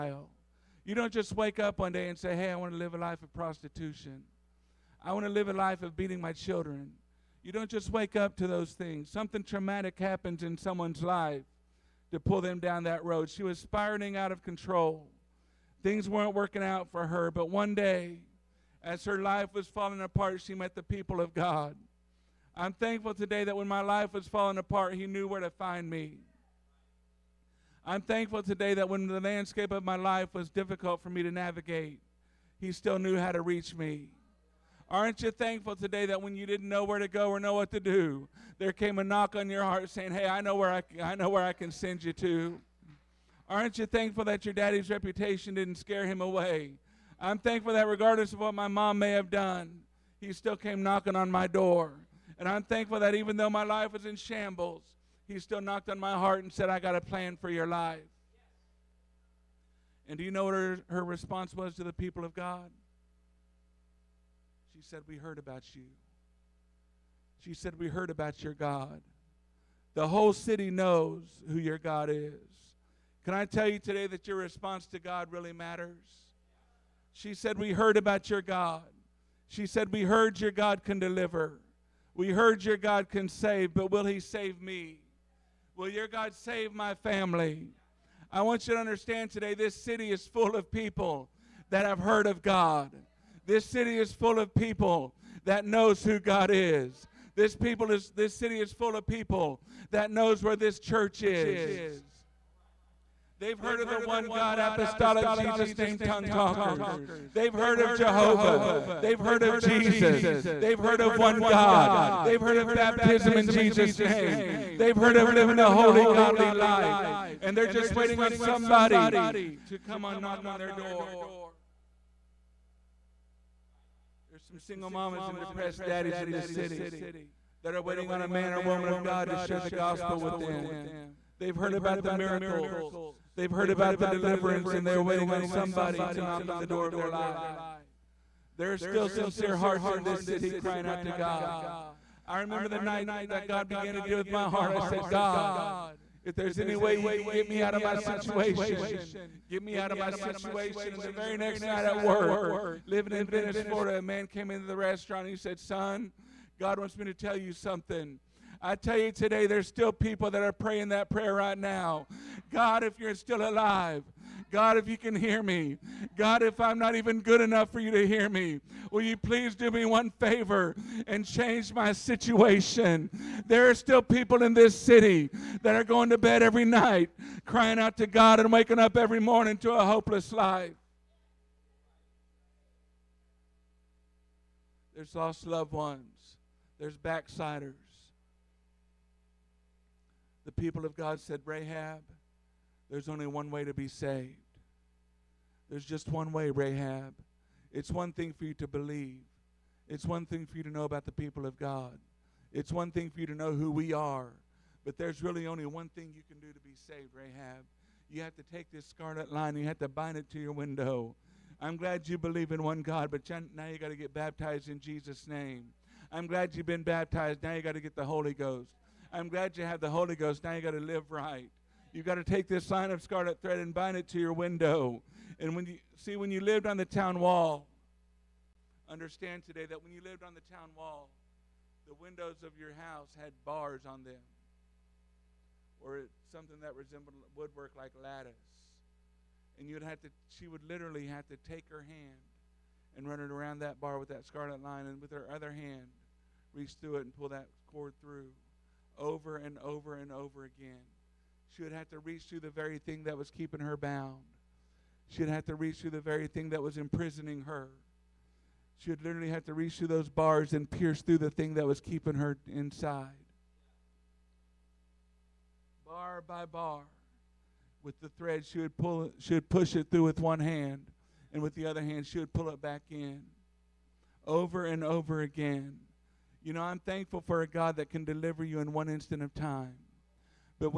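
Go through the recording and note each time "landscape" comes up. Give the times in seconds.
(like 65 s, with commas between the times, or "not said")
29 s.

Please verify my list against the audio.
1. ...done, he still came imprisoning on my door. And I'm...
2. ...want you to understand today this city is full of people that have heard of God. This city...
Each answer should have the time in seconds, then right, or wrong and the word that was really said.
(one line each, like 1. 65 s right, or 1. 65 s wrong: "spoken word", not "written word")
1. 49 s wrong: "knocking", not "imprisoning"
2. 88 s right.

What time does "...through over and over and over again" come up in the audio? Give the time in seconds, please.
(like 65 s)
247 s.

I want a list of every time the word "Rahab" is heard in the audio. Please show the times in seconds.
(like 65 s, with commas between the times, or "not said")
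191 s, 196 s, 207 s.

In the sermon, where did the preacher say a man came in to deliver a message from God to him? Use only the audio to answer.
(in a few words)
The restaurant.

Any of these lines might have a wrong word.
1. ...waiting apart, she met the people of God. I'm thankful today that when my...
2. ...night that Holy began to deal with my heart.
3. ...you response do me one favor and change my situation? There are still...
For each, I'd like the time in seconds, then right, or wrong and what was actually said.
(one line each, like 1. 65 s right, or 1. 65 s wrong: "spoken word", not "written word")
1. 19 s wrong: "falling", not "waiting"
2. 142 s wrong: "God", not "Holy"
3. 169 s wrong: "please", not "response".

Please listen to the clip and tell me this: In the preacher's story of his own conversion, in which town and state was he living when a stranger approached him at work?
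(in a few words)
Venice, Florida.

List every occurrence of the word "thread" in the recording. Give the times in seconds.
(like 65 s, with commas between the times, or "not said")
223 s, 268 s.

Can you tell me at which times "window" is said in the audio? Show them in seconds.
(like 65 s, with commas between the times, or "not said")
210 s, 224 s, 231 s.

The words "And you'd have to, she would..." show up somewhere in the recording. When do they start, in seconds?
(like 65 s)
239 s.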